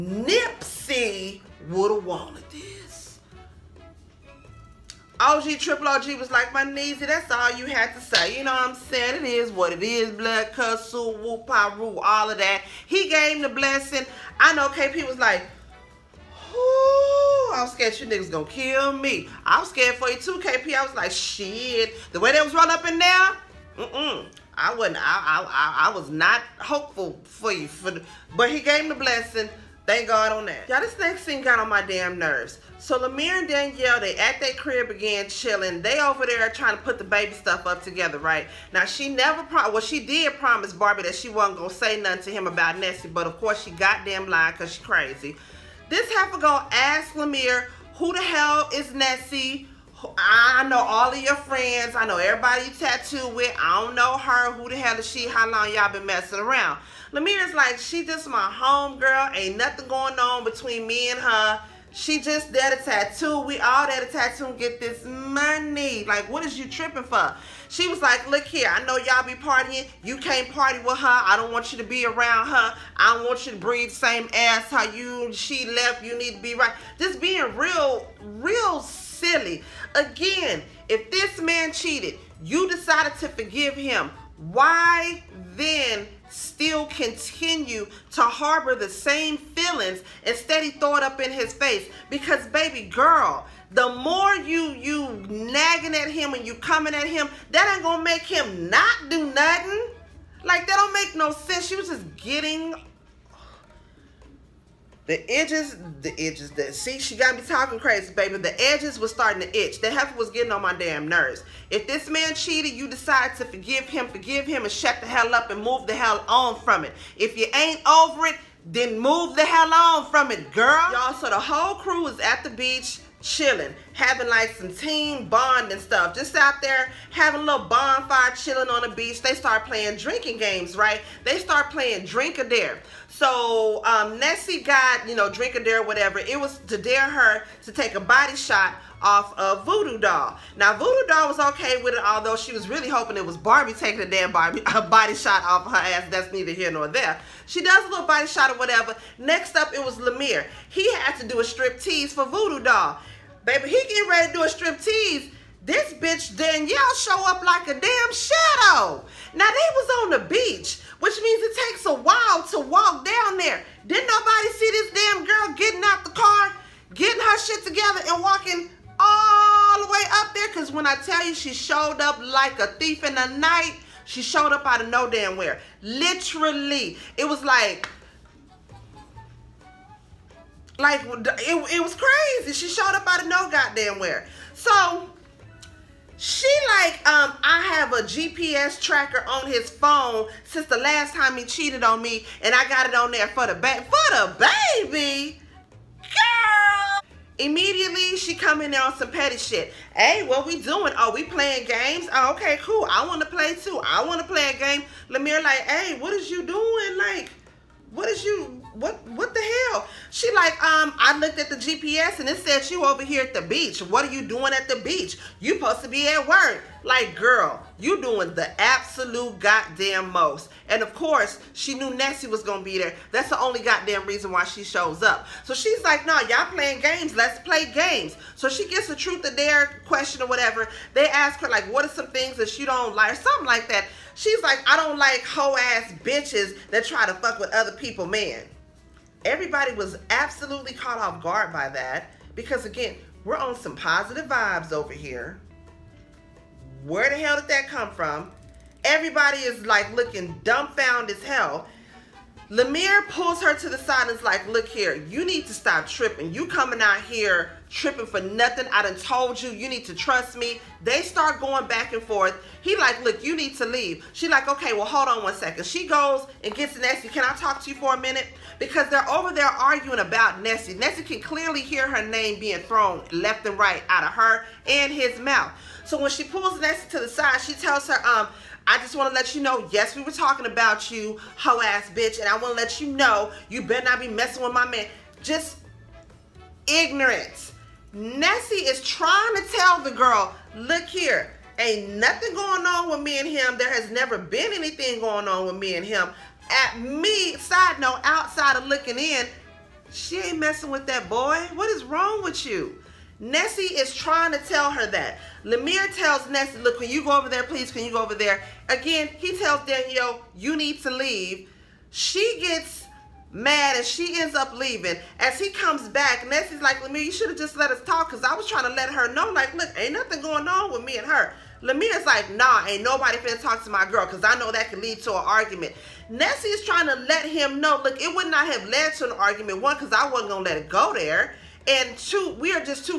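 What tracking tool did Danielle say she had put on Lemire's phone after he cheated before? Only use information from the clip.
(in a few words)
GPS tracker.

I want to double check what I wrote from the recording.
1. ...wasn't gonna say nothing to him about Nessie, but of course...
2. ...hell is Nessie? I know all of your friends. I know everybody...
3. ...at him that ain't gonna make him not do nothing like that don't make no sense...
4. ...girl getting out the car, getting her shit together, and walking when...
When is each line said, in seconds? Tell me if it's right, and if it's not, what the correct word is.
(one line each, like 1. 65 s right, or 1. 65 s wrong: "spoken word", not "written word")
1. 41 s right
2. 48 s right
3. 96 s right
4. 165 s right.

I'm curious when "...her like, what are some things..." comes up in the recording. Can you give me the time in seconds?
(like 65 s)
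231 s.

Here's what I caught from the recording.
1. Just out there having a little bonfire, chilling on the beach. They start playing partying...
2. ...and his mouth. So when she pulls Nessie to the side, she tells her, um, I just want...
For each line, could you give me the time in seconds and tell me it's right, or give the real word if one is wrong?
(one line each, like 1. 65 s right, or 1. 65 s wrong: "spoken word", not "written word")
1. 126 s wrong: "drinking", not "partying"
2. 274 s right.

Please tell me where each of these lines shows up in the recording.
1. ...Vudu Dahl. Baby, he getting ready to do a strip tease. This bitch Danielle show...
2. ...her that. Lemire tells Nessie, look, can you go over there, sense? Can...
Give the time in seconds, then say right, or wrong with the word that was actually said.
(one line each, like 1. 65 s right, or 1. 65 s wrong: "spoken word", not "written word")
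1. 152 s right
2. 304 s wrong: "please", not "sense".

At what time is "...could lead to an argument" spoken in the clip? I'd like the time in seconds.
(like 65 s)
324 s.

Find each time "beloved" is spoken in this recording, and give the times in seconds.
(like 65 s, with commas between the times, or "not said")
not said.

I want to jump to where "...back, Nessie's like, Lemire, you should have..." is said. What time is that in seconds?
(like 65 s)
315 s.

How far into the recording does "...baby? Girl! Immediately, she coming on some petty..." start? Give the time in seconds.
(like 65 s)
194 s.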